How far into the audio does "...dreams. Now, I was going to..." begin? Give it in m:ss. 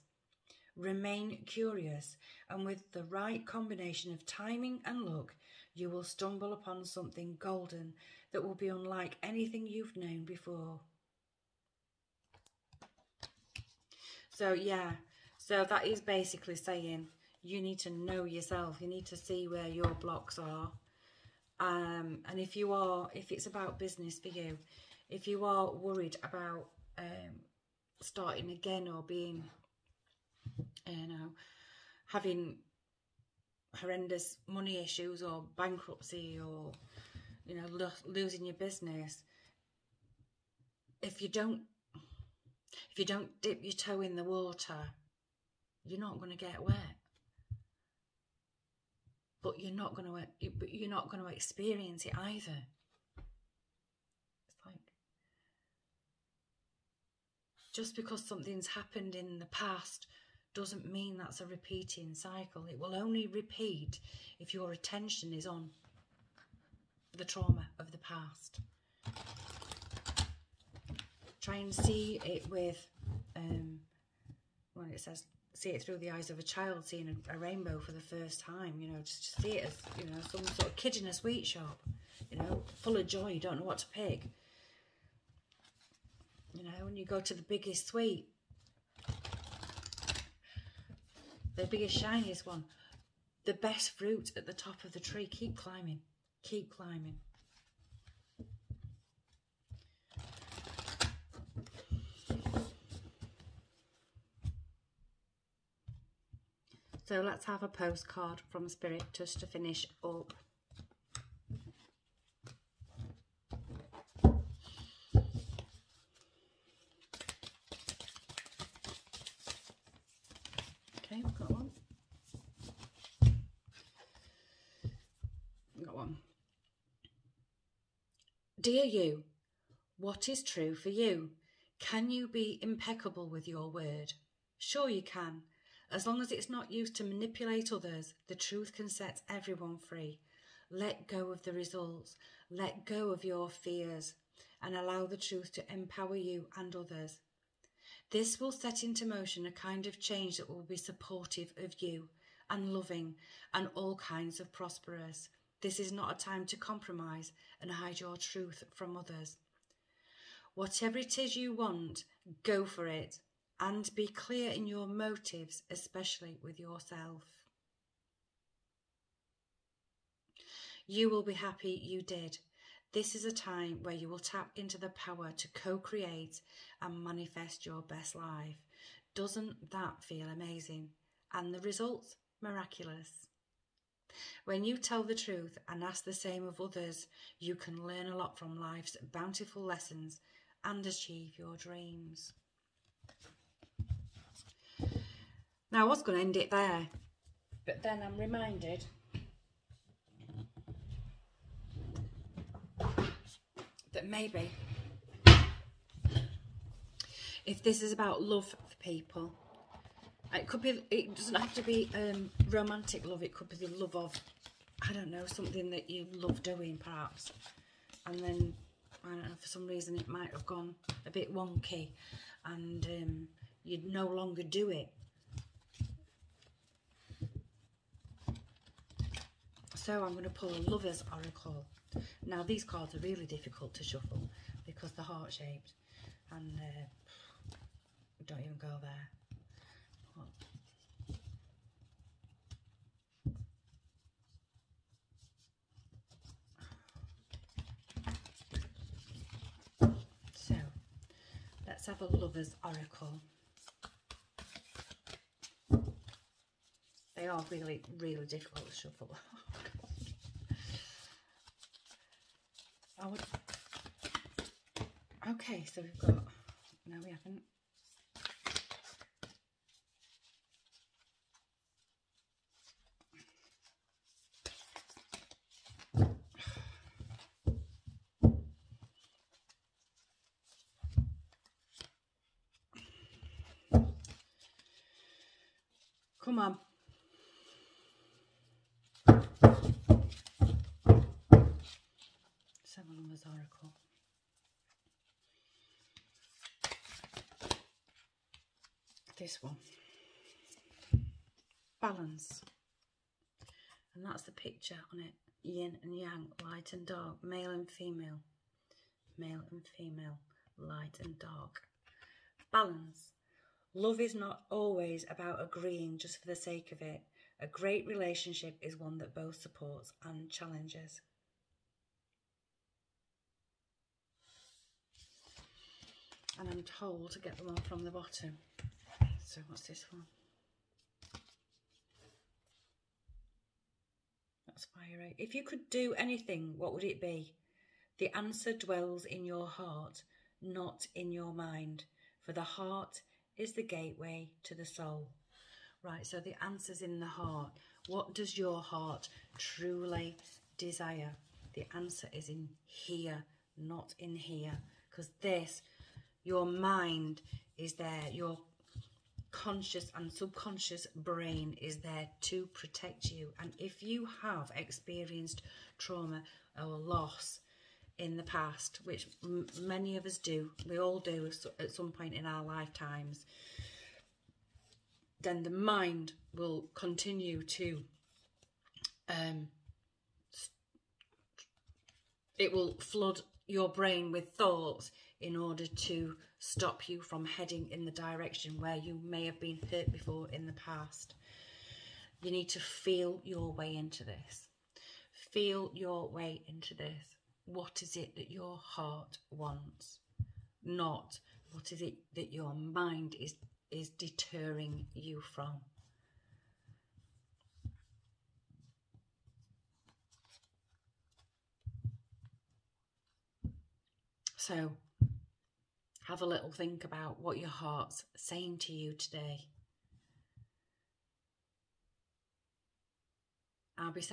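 3:11.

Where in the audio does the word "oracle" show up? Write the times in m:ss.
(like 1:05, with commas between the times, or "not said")
3:51, 4:12.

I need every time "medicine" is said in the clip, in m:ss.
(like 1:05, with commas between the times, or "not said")
not said.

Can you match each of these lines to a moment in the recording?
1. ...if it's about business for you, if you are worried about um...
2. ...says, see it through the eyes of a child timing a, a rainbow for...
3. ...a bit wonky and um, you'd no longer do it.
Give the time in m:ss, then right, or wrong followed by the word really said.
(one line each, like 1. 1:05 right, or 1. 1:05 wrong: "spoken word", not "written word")
1. 0:23 right
2. 1:14 wrong: "seeing", not "timing"
3. 3:41 right.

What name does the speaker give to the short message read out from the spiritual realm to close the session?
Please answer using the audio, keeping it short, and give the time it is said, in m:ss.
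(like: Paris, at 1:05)
postcard from Spirit, at 1:47.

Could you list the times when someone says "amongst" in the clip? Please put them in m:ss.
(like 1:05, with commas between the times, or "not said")
not said.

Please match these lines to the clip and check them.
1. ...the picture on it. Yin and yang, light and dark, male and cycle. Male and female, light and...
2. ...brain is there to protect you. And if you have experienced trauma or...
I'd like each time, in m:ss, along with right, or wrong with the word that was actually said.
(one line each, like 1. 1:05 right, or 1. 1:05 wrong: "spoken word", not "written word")
1. 5:04 wrong: "female", not "cycle"
2. 6:00 right.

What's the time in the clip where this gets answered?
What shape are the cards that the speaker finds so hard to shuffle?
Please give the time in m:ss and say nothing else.
3:55.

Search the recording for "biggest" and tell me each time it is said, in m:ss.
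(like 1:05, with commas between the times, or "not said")
1:27, 1:31.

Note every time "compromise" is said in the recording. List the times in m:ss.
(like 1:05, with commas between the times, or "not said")
2:36.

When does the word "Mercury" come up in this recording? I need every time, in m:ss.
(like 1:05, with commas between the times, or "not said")
not said.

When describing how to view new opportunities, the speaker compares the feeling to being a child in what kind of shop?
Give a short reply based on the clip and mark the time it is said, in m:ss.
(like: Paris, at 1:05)
sweet shop, at 1:21.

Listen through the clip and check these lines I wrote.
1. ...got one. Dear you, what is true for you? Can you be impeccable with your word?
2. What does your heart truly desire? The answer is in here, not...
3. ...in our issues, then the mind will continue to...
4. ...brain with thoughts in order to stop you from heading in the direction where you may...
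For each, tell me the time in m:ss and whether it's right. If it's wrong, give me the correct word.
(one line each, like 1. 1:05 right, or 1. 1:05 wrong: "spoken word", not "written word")
1. 2:05 right
2. 5:47 right
3. 6:12 wrong: "lifetimes", not "issues"
4. 6:23 right.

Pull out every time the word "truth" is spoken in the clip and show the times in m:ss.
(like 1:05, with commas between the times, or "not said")
2:18, 2:25, 2:38, 3:05.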